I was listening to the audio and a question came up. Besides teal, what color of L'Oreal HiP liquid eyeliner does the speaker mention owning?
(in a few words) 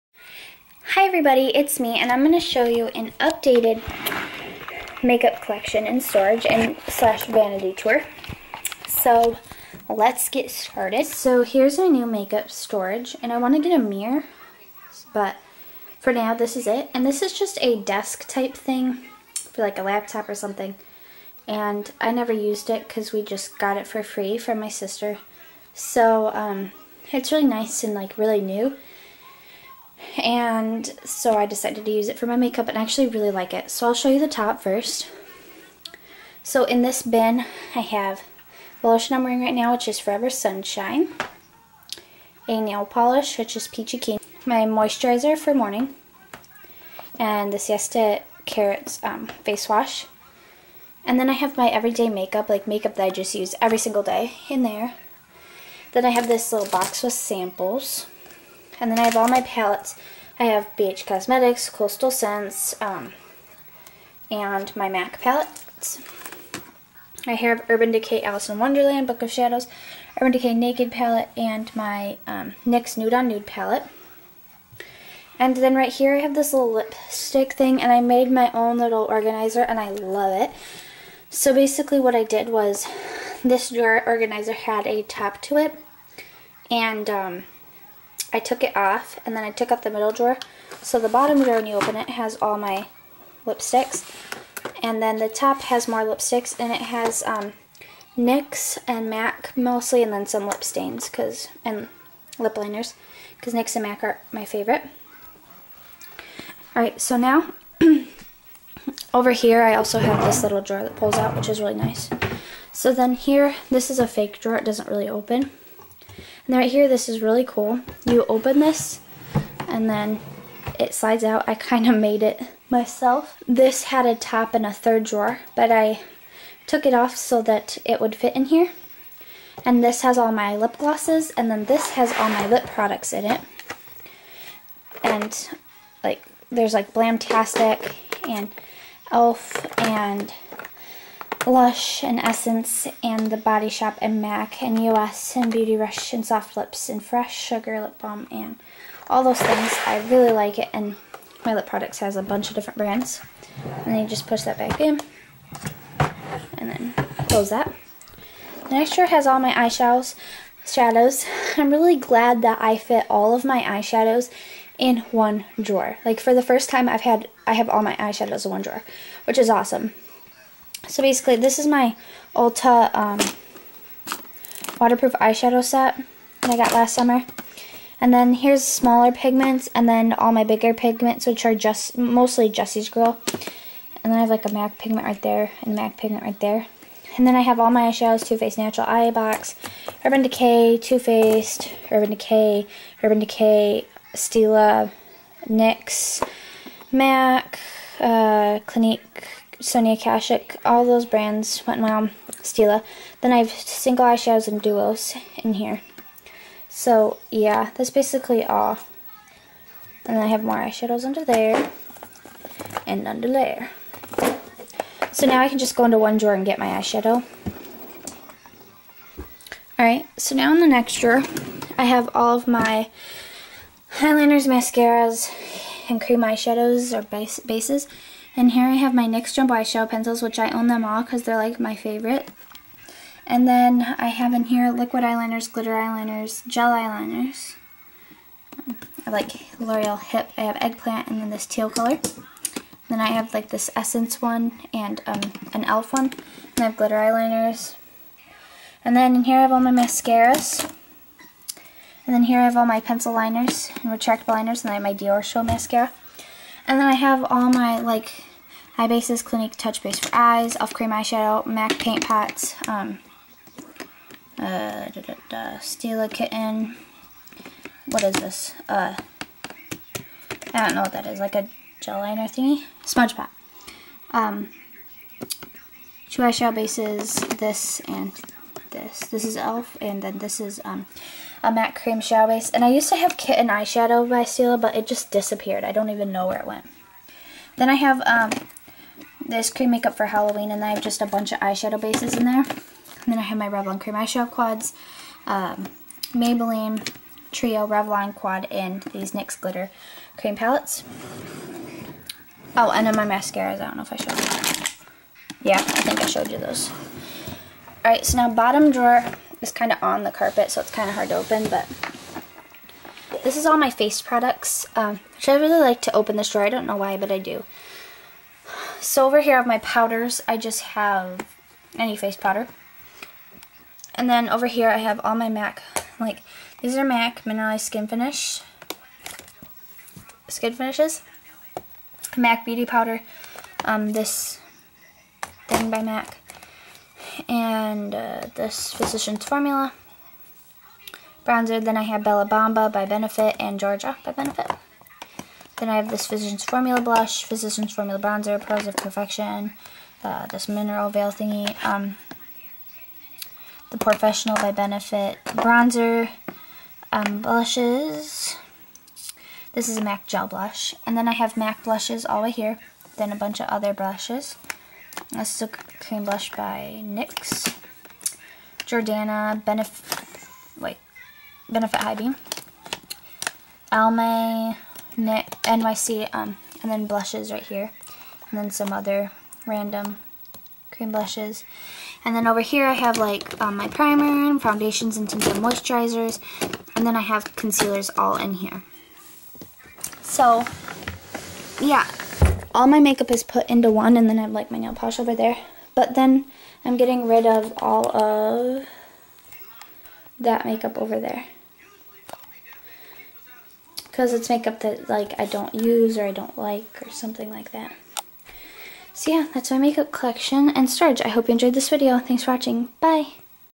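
Eggplant.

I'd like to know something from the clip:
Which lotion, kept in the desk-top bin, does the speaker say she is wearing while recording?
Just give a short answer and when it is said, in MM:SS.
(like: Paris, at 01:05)
Forever Sunshine, at 00:39.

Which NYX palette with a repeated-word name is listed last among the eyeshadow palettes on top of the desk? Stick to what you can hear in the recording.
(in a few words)
Nude on Nude.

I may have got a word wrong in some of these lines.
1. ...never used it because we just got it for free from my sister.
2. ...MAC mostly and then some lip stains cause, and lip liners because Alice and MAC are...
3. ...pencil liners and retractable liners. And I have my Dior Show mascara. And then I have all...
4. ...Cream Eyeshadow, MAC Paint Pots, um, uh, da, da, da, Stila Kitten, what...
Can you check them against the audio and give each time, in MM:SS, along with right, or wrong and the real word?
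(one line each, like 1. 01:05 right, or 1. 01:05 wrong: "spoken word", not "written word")
1. 00:22 right
2. 01:39 wrong: "NYX", not "Alice"
3. 04:12 right
4. 04:20 right.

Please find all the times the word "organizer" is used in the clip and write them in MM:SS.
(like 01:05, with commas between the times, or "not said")
01:19, 01:24.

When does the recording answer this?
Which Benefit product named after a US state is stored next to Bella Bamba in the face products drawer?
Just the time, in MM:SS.
05:43.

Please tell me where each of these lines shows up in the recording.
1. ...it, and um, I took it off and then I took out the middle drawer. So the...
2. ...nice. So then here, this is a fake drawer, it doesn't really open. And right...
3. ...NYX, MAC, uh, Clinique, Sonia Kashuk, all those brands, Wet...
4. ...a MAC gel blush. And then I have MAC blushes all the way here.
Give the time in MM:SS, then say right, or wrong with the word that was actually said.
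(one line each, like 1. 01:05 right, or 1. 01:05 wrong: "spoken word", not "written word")
1. 01:25 right
2. 01:51 right
3. 03:15 right
4. 05:59 right.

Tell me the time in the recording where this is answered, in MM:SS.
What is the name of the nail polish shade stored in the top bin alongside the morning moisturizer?
00:43.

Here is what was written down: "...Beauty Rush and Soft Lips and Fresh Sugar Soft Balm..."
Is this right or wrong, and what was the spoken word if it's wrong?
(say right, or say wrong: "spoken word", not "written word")
wrong: "Lip", not "Soft".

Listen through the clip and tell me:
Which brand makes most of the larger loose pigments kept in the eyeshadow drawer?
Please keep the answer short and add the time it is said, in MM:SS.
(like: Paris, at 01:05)
Jesse's Girl, at 03:02.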